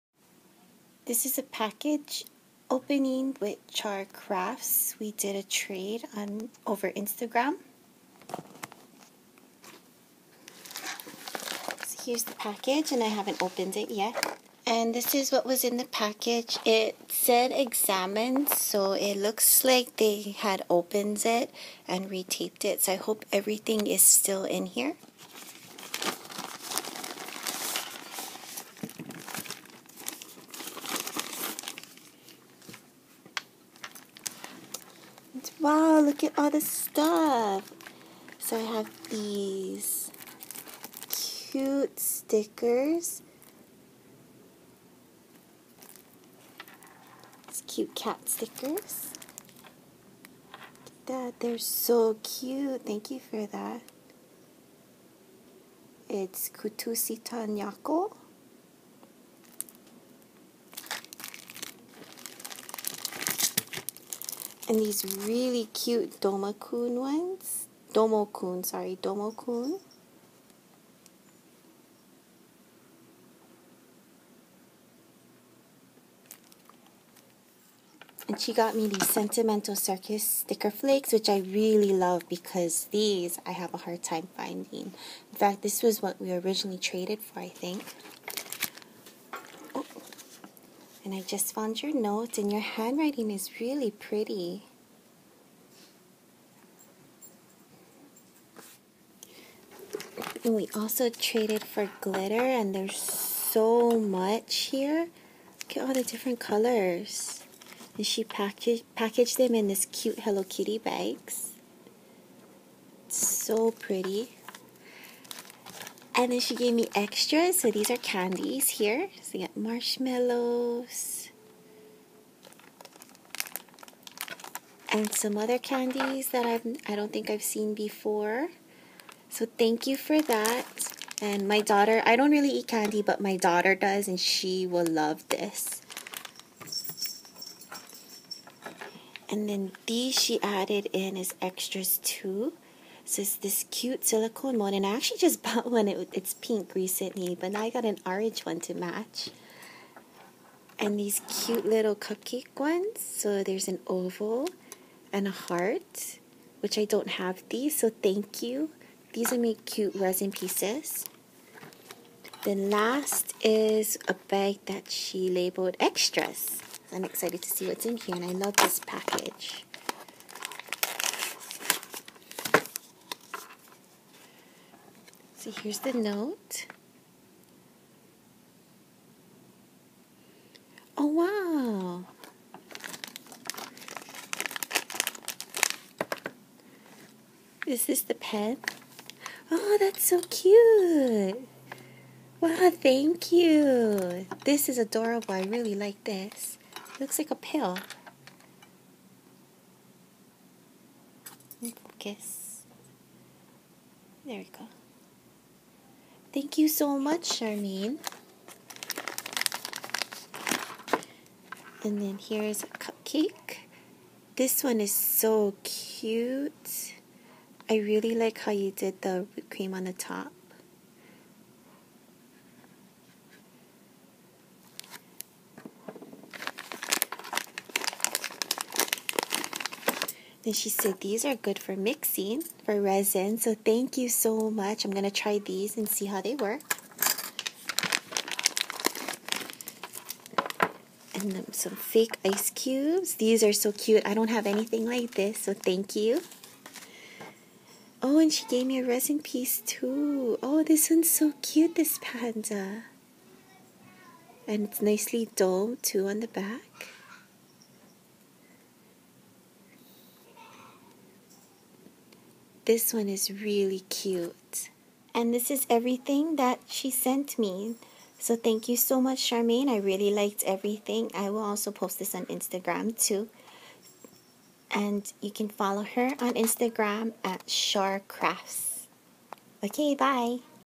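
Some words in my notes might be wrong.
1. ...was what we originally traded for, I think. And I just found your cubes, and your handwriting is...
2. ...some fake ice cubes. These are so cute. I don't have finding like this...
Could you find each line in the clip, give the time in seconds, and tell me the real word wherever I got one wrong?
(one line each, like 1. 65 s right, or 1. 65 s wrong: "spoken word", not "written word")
1. 85 s wrong: "notes", not "cubes"
2. 241 s wrong: "anything", not "finding".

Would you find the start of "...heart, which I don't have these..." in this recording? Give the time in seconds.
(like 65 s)
155 s.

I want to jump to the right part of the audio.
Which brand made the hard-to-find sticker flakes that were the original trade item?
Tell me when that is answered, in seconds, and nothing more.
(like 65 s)
79 s.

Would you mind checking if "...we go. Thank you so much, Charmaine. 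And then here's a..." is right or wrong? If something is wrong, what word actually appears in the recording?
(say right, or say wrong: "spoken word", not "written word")
right.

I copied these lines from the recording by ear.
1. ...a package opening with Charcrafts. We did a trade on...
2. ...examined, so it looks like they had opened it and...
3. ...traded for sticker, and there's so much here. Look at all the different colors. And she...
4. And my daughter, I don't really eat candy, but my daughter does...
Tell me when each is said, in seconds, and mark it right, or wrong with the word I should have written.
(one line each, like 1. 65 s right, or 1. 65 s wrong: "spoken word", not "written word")
1. 1 s right
2. 17 s right
3. 101 s wrong: "glitter", not "sticker"
4. 131 s right.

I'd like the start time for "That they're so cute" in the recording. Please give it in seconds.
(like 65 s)
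51 s.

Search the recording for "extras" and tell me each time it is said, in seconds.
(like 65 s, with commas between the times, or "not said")
116 s, 141 s, 165 s.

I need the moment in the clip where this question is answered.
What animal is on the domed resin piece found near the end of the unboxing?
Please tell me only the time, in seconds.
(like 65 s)
252 s.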